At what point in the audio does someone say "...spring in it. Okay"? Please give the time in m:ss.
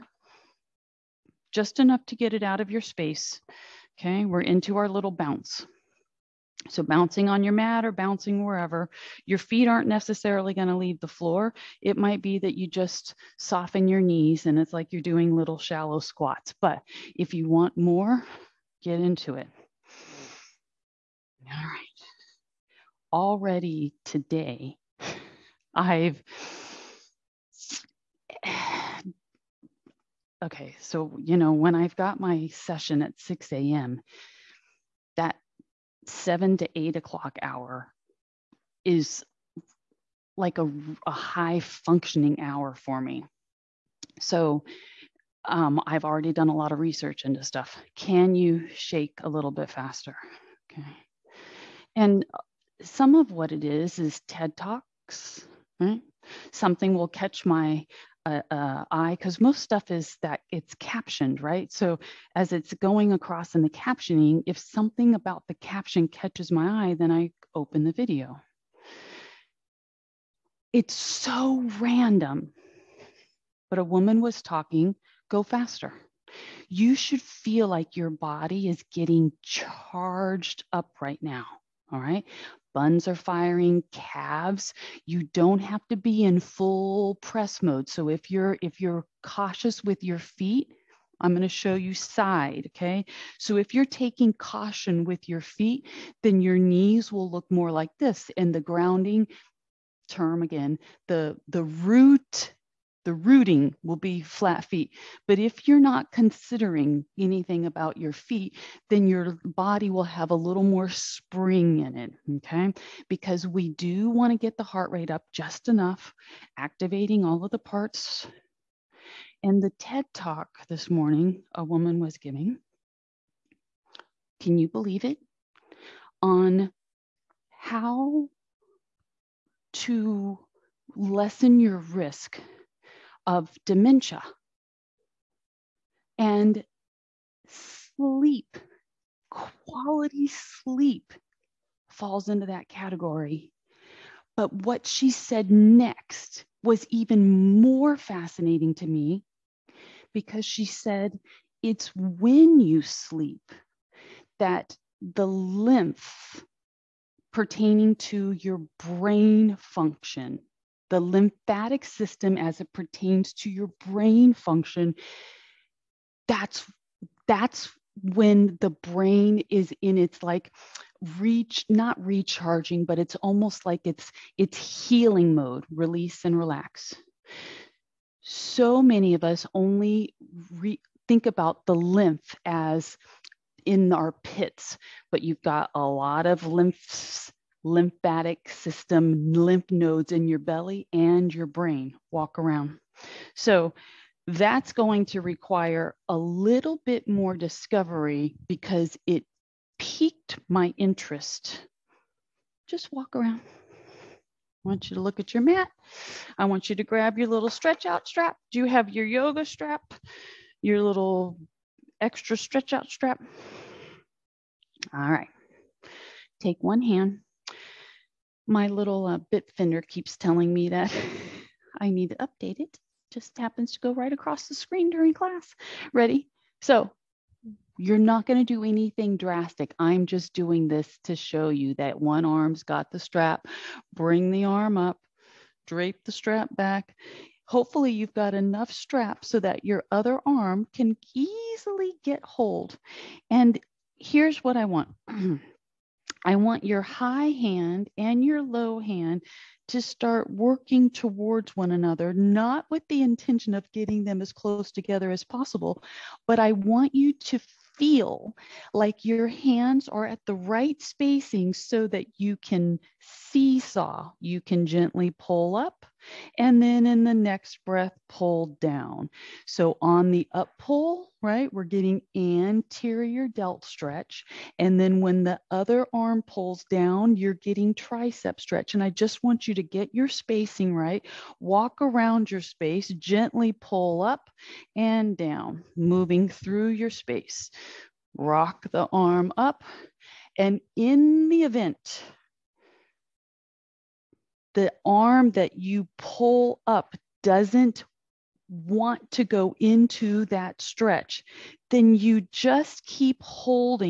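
1:50.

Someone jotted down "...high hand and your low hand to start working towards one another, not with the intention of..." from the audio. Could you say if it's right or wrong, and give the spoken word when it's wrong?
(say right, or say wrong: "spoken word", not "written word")
right.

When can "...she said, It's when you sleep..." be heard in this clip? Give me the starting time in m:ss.
2:30.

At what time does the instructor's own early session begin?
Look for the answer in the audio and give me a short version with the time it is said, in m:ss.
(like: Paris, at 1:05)
6 a.m., at 0:33.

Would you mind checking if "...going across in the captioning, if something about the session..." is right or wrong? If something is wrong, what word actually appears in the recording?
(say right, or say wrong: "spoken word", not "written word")
wrong: "caption", not "session".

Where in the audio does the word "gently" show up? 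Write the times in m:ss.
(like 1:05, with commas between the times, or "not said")
4:24, 4:42.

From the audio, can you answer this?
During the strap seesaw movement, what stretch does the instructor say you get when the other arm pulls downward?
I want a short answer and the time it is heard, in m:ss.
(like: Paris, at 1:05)
tricep stretch, at 4:37.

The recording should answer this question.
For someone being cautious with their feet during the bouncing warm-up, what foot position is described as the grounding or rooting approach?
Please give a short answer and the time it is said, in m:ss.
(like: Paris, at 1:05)
flat feet, at 1:44.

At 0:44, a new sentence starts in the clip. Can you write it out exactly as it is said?
So um, I've already done a lot of research into stuff.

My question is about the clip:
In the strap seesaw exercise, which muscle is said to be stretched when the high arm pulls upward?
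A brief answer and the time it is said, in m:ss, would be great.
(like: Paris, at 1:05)
anterior delt, at 4:32.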